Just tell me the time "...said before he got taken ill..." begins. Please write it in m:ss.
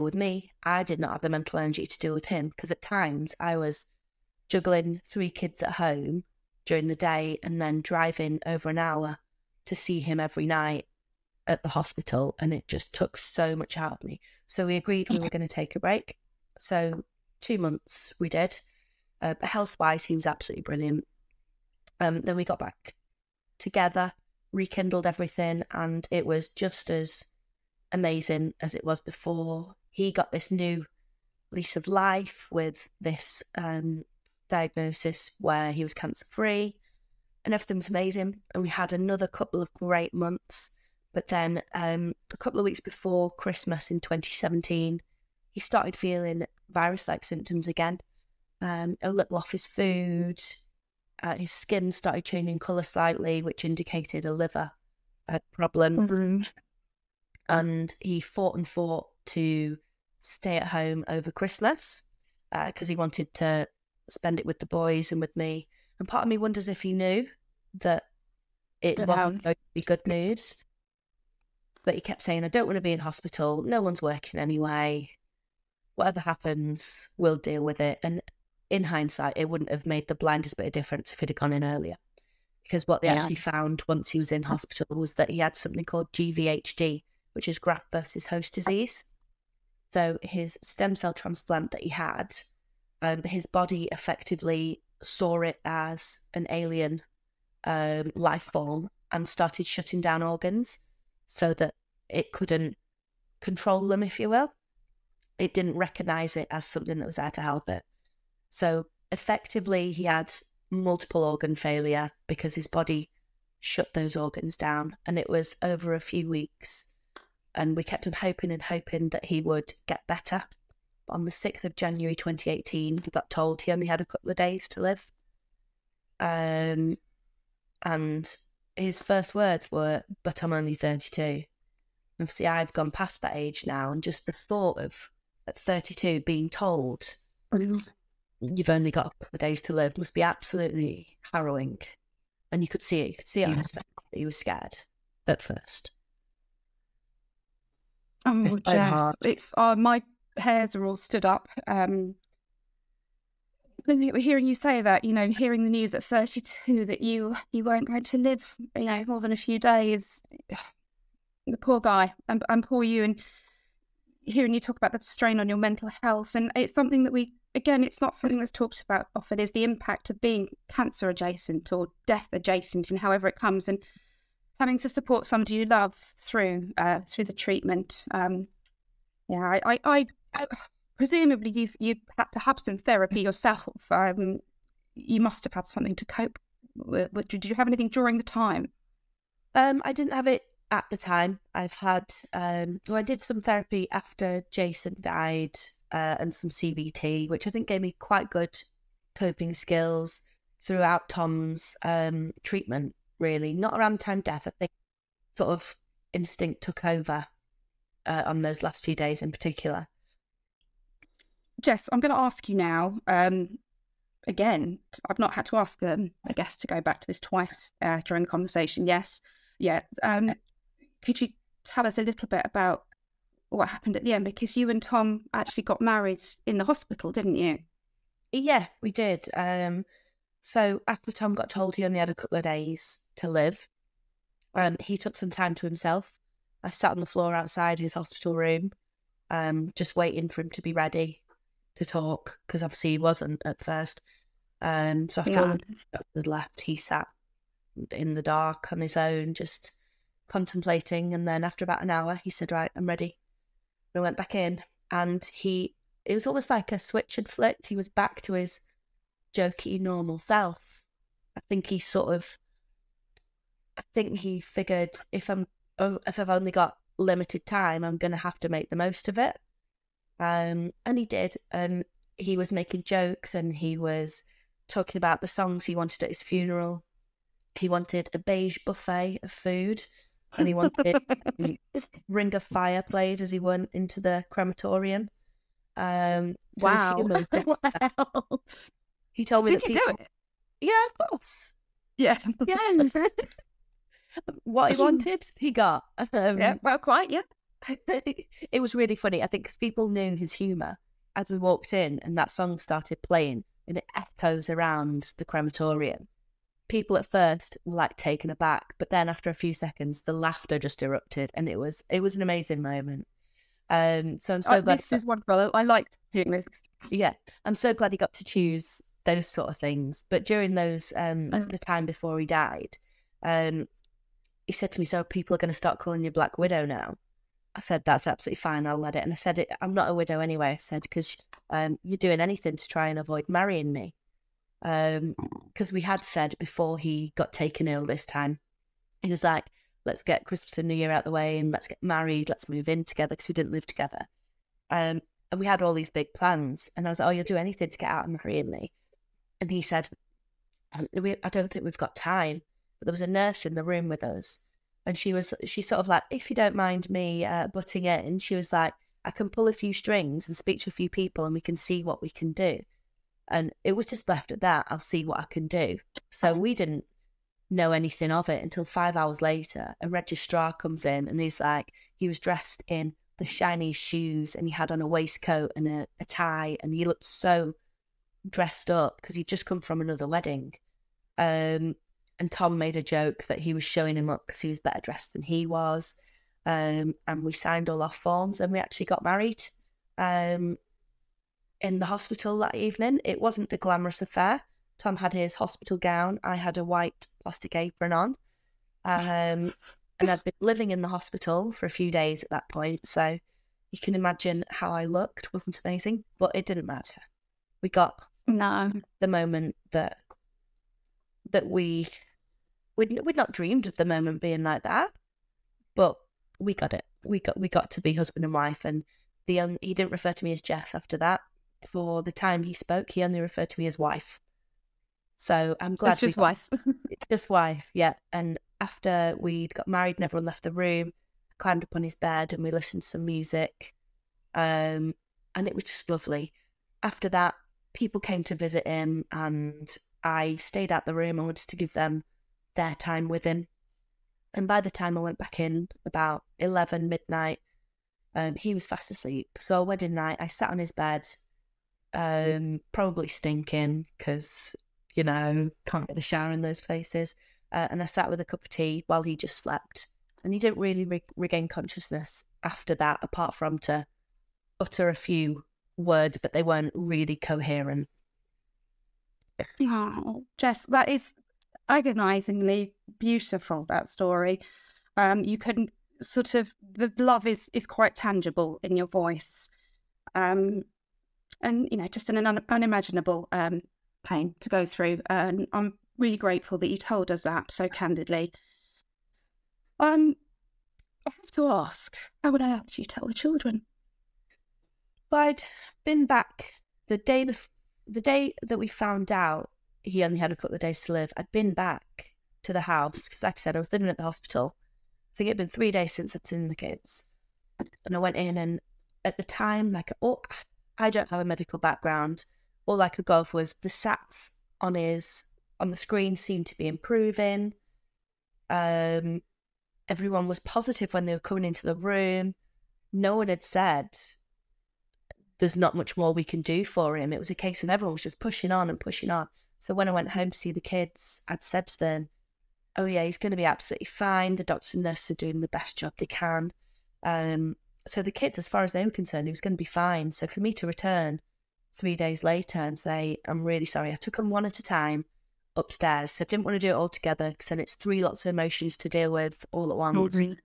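5:36.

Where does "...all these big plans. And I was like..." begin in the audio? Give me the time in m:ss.
5:45.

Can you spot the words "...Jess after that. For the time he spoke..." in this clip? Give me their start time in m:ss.
7:00.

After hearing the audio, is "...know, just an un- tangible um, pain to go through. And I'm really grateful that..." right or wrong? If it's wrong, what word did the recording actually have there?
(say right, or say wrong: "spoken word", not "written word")
wrong: "unimaginable", not "tangible".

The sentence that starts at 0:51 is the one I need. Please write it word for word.
Uh, his skin started changing colour slightly, which indicated a liver uh, problem.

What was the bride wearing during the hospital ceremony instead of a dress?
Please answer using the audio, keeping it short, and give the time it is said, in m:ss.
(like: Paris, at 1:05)
White plastic apron, at 6:36.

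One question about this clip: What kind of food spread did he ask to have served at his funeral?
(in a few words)
Beige buffet.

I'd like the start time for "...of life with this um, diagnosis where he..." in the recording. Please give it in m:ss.
0:31.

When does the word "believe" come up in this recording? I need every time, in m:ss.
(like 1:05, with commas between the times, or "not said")
not said.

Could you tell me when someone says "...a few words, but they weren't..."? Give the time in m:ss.
7:44.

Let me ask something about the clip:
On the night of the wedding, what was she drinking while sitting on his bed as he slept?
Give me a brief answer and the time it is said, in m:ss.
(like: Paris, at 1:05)
Cup of tea, at 7:38.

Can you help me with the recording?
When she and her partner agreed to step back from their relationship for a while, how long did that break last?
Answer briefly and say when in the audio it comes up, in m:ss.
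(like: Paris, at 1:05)
2 months, at 0:17.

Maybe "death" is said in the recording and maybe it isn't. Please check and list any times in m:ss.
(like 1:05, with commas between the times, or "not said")
2:52, 3:24.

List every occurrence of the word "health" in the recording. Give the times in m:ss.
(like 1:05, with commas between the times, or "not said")
0:19, 2:46.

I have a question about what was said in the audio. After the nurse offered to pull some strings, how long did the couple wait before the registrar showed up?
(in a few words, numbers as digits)
5 hours.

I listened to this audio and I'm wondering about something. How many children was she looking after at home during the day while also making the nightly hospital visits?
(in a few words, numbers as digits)
3.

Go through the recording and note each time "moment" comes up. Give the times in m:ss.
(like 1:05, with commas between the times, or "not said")
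5:12, 6:49, 6:53.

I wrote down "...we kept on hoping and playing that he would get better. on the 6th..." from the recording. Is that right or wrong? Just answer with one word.
wrong.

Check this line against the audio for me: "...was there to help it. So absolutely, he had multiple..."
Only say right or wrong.
wrong.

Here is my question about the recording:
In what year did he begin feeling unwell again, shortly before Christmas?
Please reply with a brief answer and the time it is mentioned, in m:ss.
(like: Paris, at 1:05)
2017, at 0:44.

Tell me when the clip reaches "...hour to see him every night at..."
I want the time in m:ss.
0:08.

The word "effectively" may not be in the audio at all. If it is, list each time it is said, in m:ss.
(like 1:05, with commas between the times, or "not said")
1:33, 1:49.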